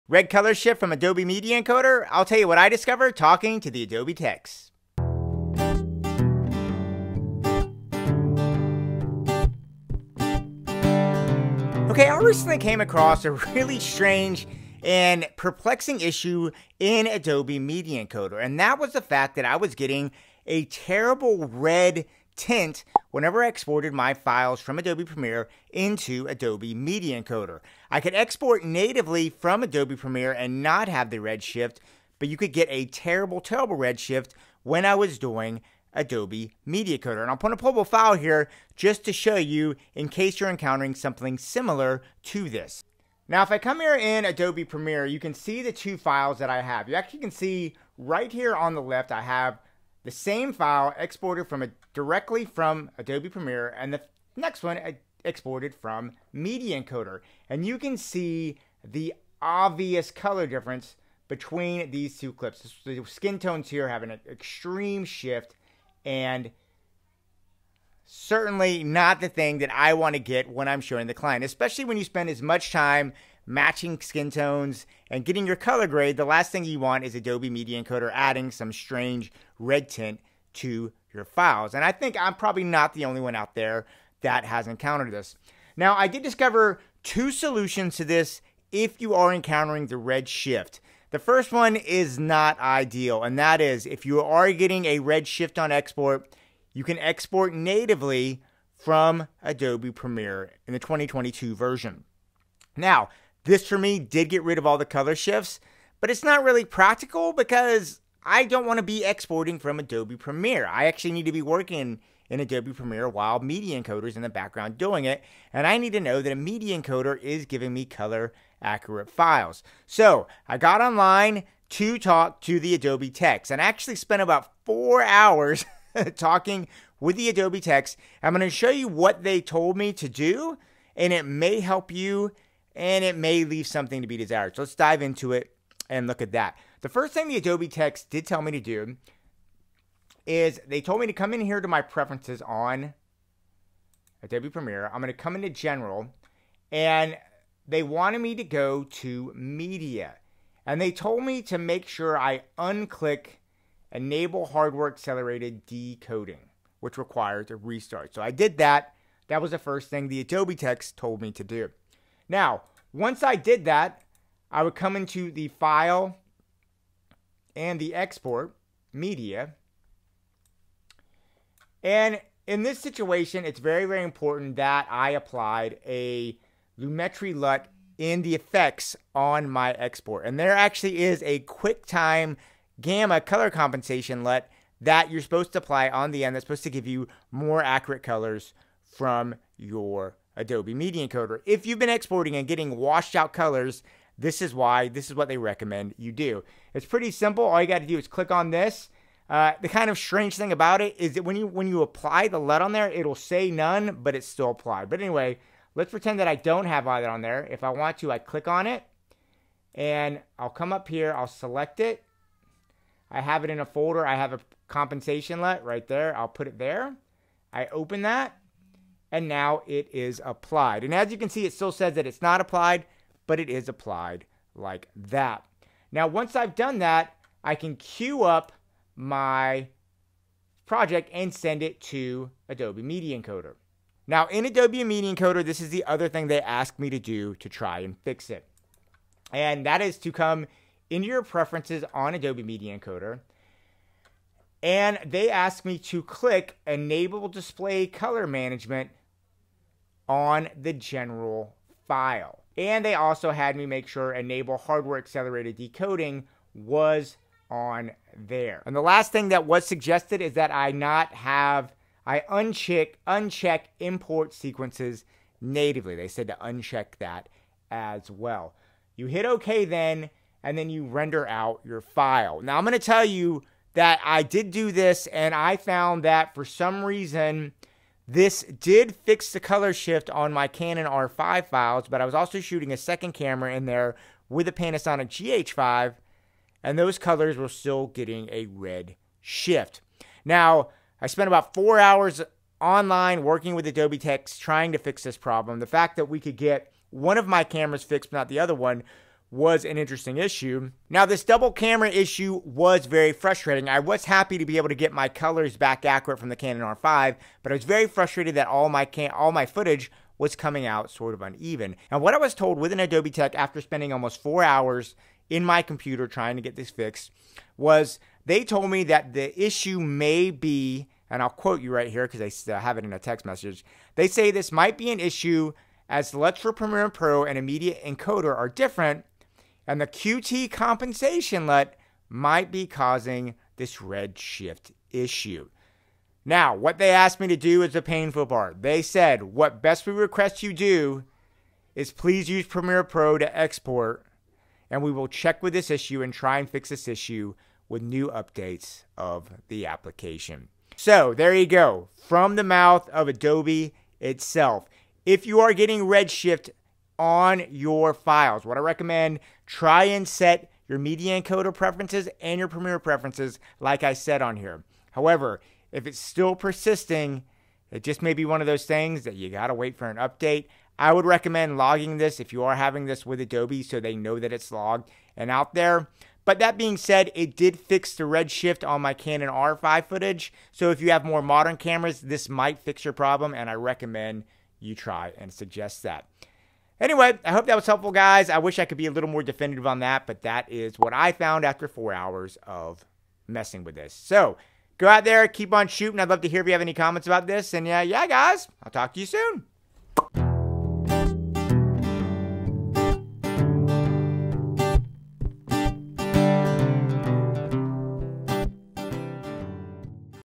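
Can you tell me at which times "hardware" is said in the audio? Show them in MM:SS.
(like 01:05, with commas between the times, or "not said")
02:34, 04:14.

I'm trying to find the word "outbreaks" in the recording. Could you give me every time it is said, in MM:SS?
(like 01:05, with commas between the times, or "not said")
not said.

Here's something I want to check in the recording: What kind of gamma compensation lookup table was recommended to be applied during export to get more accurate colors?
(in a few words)
QuickTime.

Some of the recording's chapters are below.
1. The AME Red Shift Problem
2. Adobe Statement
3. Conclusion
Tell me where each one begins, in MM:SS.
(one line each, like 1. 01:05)
1. 00:15
2. 05:11
3. 05:50.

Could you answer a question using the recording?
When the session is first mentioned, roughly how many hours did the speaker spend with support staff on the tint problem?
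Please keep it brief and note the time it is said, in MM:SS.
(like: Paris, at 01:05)
4, at 02:04.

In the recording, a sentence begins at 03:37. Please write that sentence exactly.
I open that, and now it is applied.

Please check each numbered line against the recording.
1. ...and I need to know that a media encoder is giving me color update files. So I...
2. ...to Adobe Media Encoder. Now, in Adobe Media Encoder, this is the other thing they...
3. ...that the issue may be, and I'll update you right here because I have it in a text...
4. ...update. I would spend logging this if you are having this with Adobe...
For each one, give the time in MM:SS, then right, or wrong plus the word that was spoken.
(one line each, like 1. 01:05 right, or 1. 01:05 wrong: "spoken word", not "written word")
1. 01:55 wrong: "accurate", not "update"
2. 03:51 right
3. 05:18 wrong: "quote", not "update"
4. 06:09 wrong: "recommend", not "spend".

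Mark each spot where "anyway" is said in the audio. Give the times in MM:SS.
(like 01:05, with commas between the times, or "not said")
03:24, 06:26.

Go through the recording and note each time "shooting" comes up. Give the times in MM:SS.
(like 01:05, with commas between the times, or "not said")
04:42, 06:35.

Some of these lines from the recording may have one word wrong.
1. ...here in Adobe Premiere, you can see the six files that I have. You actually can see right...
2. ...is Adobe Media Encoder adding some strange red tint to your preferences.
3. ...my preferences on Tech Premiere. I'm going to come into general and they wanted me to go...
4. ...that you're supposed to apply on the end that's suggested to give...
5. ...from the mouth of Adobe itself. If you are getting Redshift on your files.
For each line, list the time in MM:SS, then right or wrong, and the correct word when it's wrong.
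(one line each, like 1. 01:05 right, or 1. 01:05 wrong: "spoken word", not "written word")
1. 00:43 wrong: "two", not "six"
2. 01:17 wrong: "files", not "preferences"
3. 02:21 wrong: "Adobe", not "Tech"
4. 03:04 wrong: "supposed", not "suggested"
5. 05:51 right.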